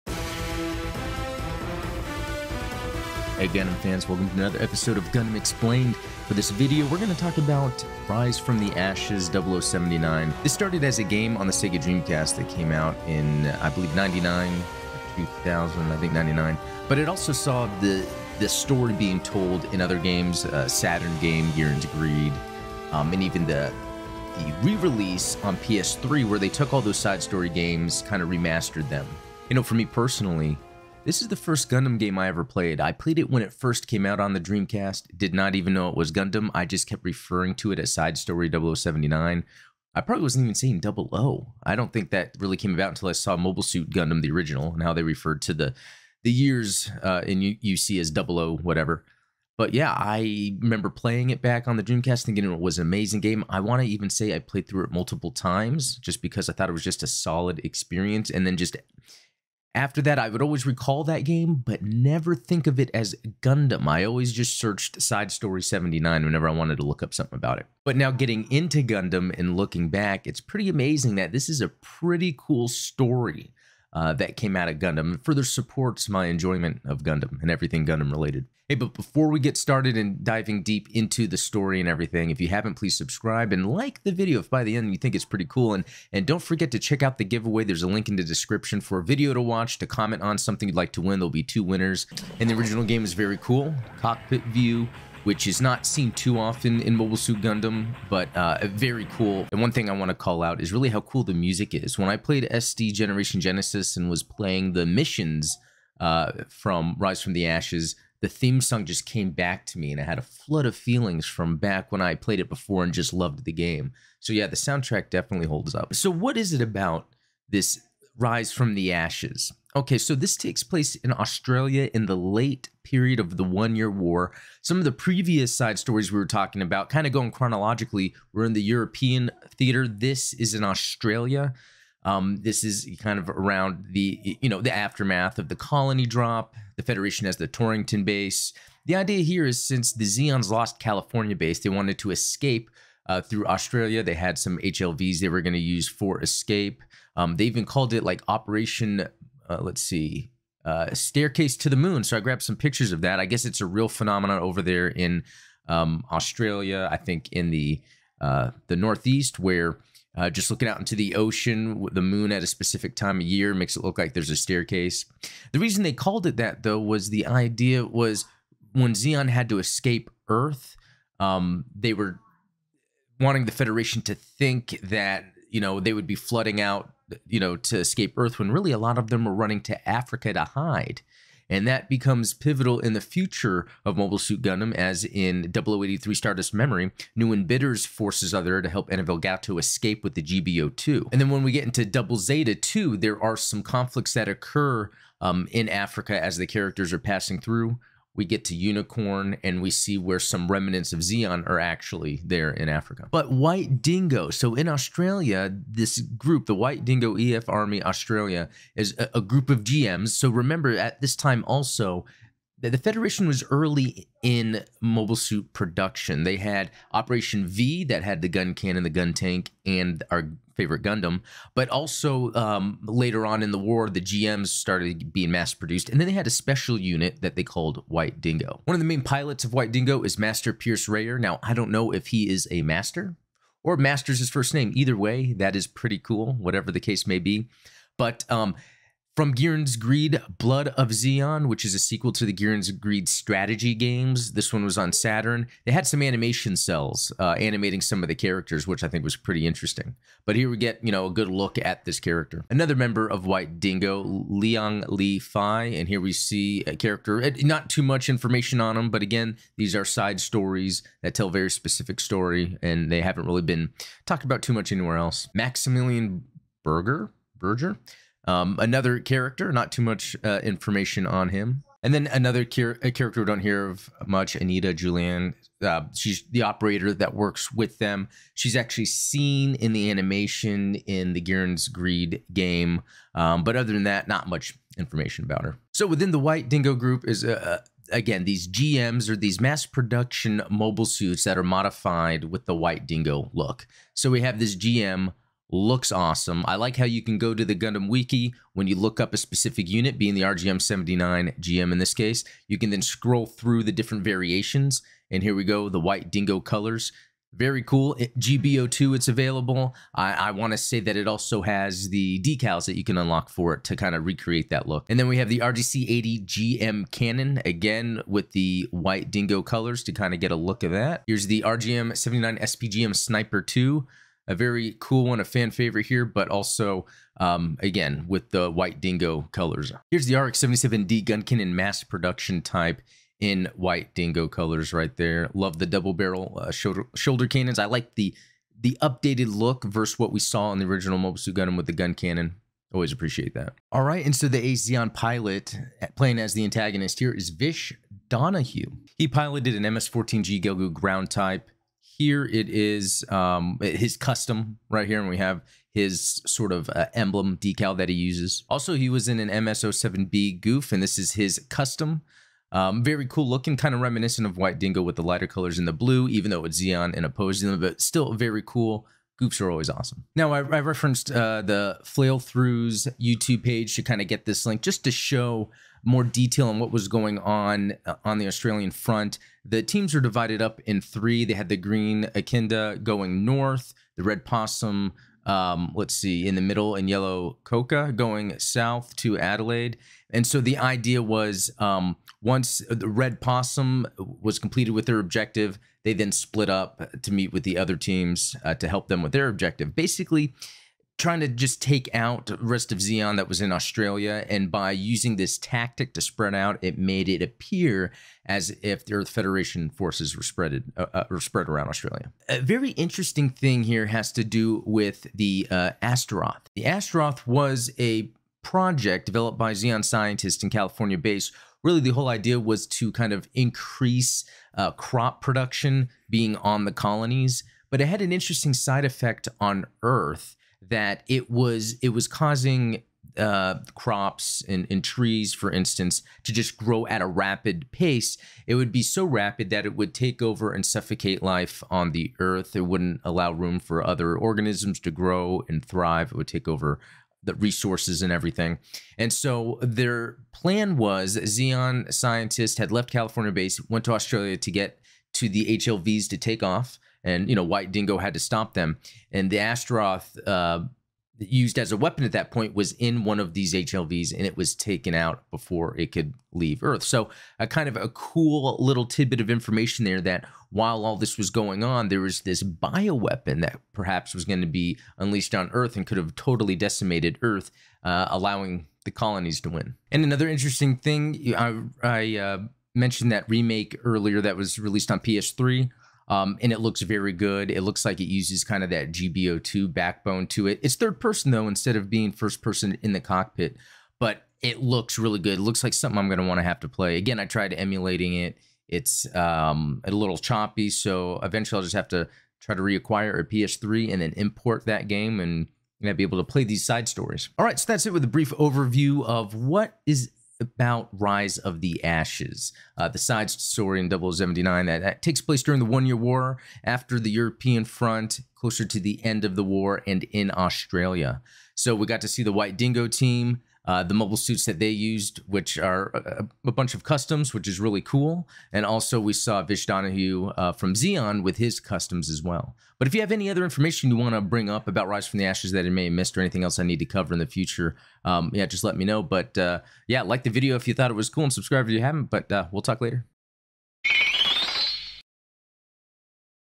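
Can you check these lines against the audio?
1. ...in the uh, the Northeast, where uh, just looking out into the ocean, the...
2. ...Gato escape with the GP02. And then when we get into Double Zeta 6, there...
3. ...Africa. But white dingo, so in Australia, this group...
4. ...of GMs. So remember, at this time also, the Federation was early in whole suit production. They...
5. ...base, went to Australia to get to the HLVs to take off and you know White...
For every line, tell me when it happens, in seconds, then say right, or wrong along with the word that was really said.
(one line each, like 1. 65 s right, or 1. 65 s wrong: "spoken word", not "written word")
1. 157 s right
2. 188 s wrong: "2", not "6"
3. 202 s right
4. 209 s wrong: "mobile", not "whole"
5. 453 s right.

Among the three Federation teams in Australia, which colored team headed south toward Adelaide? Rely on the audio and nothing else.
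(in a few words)
Yellow Coca.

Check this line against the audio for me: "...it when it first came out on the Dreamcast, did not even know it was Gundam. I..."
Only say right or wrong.
right.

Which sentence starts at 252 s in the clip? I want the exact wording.
Another member of White Dingo, Liang Li Fi.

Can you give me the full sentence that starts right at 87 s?
There's a link in the description for a video to watch, to comment on something you'd like to win.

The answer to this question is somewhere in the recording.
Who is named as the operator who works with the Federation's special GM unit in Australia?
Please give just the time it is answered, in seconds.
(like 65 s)
274 s.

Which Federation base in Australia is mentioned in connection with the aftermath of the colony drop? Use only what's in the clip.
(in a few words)
Torrington base.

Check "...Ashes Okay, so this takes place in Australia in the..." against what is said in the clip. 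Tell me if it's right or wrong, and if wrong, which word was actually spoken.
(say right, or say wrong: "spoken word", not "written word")
right.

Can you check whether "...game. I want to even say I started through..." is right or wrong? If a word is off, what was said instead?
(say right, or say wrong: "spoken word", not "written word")
wrong: "played", not "started".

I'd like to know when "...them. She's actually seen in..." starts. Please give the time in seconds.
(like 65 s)
277 s.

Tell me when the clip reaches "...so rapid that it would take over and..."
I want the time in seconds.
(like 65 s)
438 s.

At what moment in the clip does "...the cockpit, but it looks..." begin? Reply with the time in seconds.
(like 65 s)
492 s.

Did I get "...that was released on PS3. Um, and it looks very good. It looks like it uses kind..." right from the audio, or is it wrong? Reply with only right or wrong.
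right.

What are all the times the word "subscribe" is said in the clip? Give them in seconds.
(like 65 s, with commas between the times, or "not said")
82 s, 541 s.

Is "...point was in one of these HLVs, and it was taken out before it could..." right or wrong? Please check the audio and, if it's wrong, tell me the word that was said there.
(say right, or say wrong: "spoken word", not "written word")
right.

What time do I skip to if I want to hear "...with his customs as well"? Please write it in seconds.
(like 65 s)
531 s.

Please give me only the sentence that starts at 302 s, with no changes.
You can then scroll through the different variations.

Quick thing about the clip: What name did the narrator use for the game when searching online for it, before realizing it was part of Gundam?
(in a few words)
Side Story 79.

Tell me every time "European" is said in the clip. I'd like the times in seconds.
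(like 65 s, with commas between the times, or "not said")
128 s, 517 s.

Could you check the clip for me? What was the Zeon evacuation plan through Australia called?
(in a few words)
Staircase to the moon.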